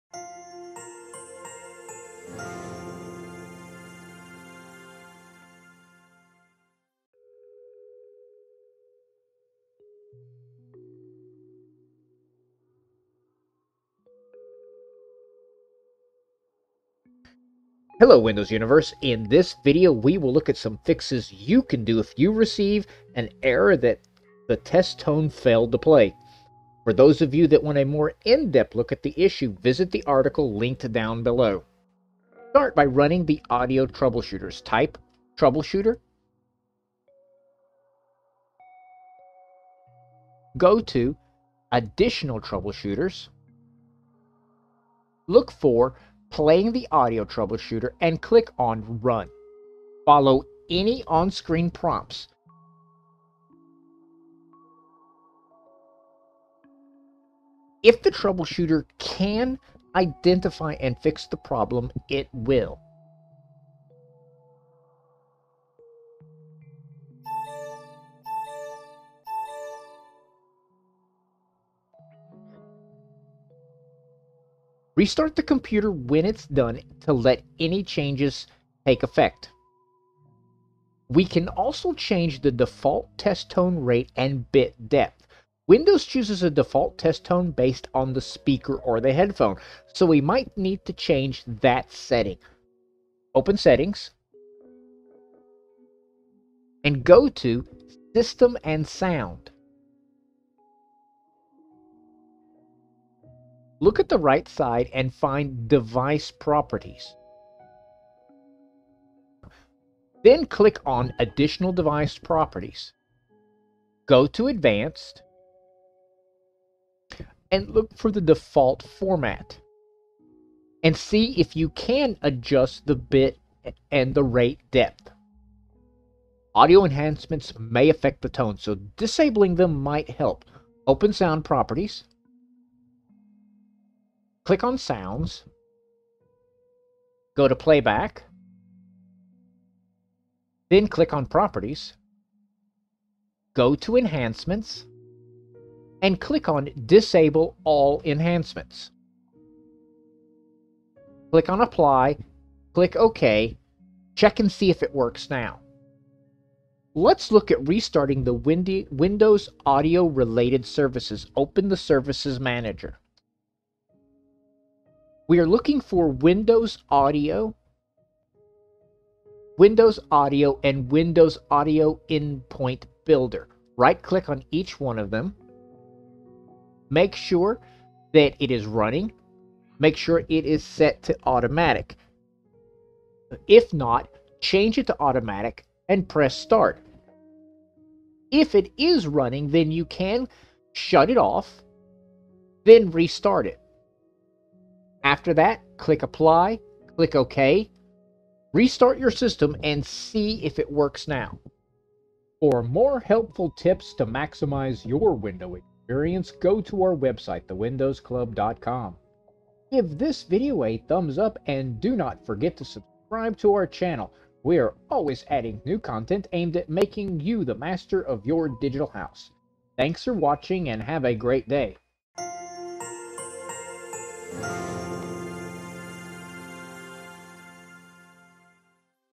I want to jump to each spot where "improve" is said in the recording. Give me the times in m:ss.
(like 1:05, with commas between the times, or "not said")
not said.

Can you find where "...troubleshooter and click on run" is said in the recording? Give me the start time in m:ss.
0:47.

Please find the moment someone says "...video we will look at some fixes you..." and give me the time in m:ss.
0:19.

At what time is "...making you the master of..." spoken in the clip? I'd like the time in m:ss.
3:36.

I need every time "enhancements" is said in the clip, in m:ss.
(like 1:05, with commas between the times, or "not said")
2:06, 2:23, 2:28.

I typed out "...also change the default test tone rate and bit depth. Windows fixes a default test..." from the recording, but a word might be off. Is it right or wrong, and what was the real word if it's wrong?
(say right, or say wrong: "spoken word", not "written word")
wrong: "chooses", not "fixes".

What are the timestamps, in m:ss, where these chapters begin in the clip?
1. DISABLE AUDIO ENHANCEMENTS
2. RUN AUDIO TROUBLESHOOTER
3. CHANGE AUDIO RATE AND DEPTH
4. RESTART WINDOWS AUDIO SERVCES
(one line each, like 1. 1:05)
1. 2:05
2. 0:32
3. 1:20
4. 2:56.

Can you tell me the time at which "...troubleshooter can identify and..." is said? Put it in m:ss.
0:58.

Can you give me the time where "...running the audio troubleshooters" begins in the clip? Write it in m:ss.
0:32.